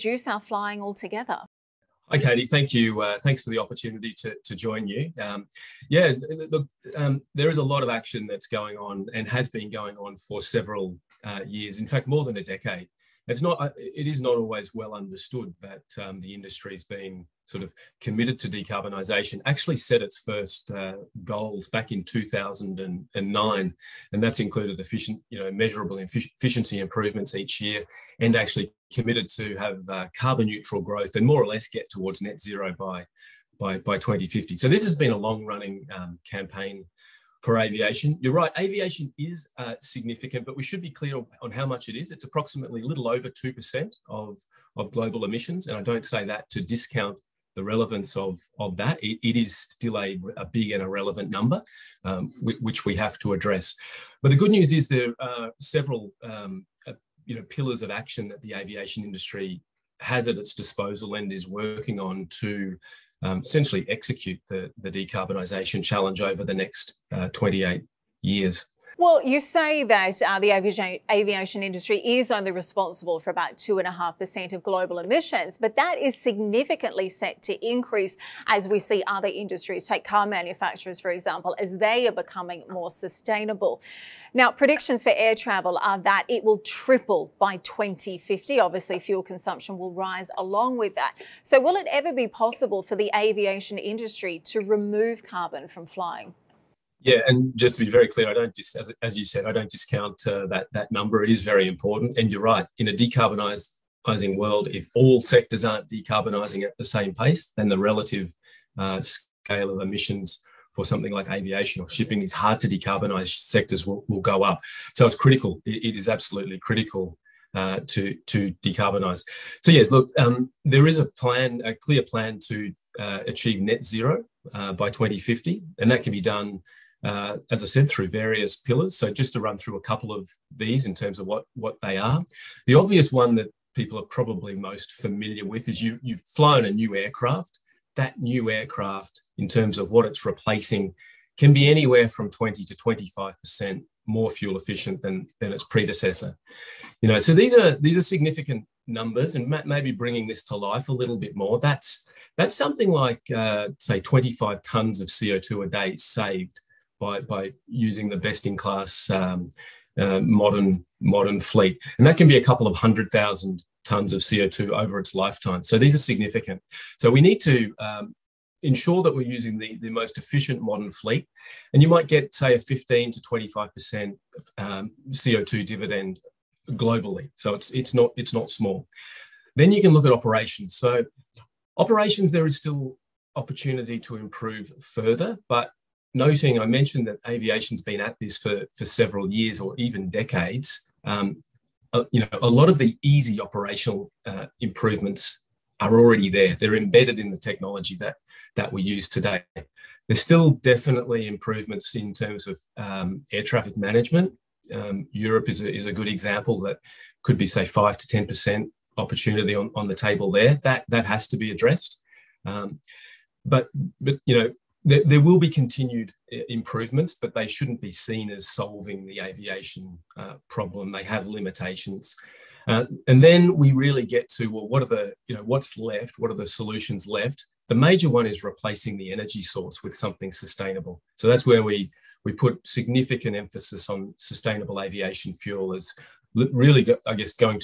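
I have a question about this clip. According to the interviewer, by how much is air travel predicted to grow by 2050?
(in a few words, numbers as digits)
triple.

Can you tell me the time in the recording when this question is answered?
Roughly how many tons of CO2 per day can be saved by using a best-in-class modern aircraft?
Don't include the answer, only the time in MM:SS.
02:34.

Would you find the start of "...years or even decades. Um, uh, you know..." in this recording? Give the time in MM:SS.
03:09.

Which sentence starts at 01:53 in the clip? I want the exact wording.
Sectors will, will go up, so it's critical.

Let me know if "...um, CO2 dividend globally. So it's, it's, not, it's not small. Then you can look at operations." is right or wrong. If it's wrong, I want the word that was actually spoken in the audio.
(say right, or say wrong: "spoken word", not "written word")
right.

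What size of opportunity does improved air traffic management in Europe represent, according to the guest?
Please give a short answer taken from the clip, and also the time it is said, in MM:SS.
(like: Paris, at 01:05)
5 to 10 percent, at 03:27.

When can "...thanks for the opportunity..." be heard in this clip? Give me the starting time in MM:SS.
00:03.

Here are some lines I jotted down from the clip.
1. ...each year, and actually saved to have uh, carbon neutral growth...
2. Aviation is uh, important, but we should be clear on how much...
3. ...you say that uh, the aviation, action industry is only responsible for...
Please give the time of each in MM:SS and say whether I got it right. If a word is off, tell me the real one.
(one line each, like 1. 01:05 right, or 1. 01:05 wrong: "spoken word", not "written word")
1. 00:27 wrong: "committed", not "saved"
2. 00:38 wrong: "significant", not "important"
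3. 01:09 wrong: "aviation", not "action".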